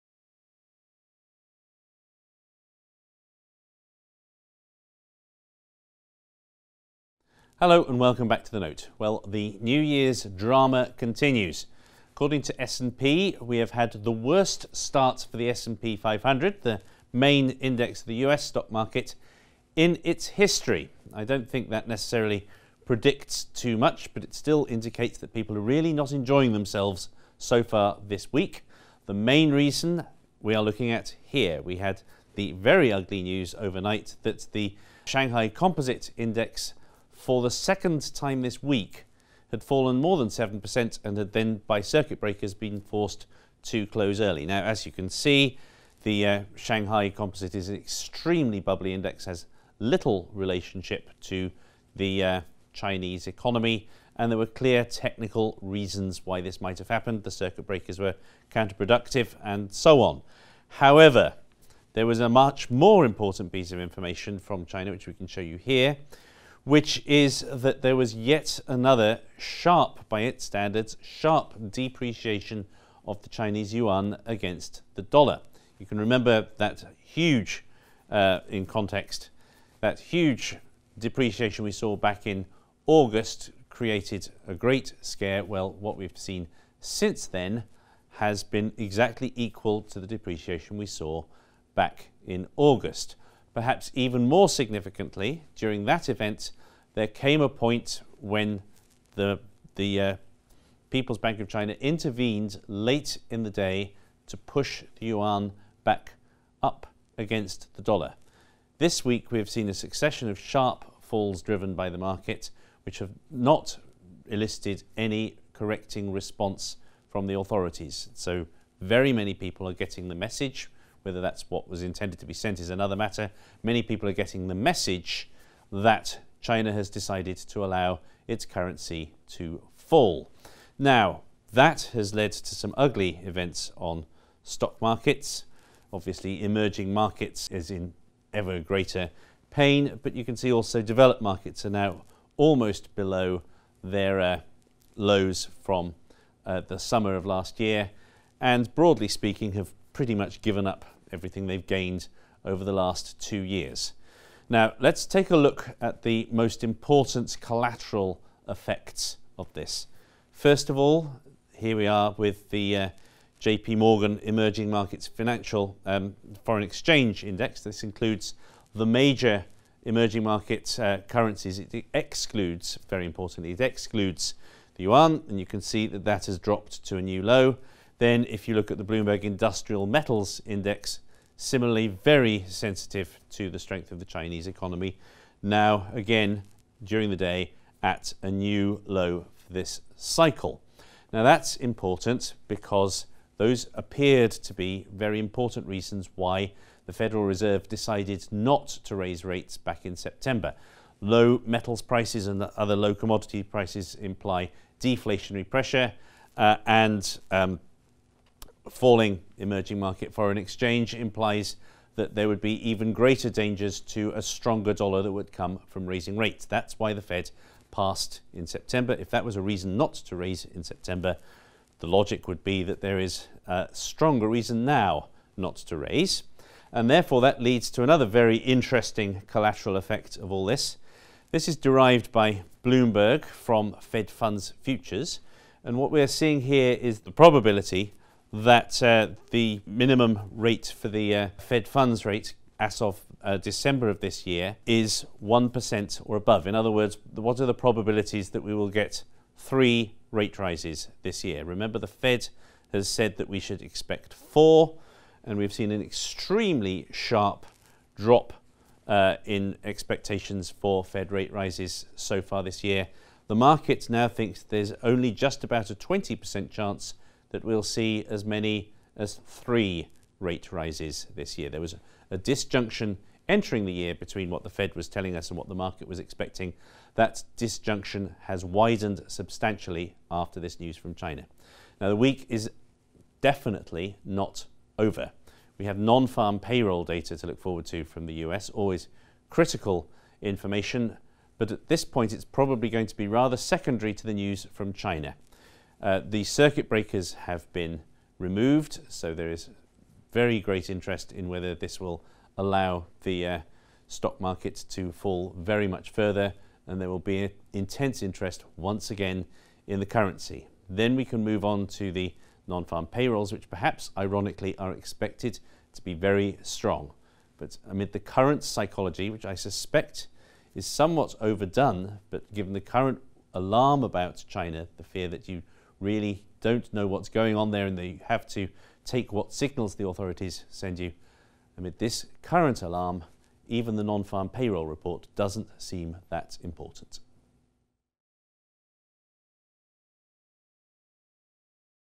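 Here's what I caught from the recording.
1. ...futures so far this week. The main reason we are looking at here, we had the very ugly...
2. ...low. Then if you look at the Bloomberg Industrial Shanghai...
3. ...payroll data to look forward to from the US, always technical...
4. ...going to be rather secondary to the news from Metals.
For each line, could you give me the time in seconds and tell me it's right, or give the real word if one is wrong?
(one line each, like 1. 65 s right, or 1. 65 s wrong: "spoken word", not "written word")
1. 26 s wrong: "themselves", not "futures"
2. 177 s wrong: "Metals", not "Shanghai"
3. 286 s wrong: "critical", not "technical"
4. 292 s wrong: "China", not "Metals".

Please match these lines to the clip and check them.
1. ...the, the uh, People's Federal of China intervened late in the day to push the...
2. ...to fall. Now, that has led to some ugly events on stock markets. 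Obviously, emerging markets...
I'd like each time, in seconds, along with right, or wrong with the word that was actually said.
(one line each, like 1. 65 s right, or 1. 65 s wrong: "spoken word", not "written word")
1. 99 s wrong: "Bank", not "Federal"
2. 129 s right.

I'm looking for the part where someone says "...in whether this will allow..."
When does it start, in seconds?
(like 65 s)
301 s.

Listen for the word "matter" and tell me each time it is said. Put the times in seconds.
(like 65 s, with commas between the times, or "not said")
122 s.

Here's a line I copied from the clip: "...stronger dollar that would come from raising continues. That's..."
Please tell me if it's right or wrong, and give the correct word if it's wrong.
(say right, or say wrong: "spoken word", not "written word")
wrong: "rates", not "continues".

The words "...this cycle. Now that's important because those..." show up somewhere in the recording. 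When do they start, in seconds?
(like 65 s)
189 s.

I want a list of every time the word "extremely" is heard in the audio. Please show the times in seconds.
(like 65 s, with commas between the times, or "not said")
47 s, 255 s.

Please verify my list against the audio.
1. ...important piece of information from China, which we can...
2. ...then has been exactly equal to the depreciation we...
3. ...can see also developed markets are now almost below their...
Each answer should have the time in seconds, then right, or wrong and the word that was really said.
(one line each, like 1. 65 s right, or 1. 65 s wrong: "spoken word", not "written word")
1. 63 s right
2. 87 s right
3. 140 s right.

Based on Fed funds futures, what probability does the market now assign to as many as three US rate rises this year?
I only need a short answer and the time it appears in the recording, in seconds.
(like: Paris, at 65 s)
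20%, at 265 s.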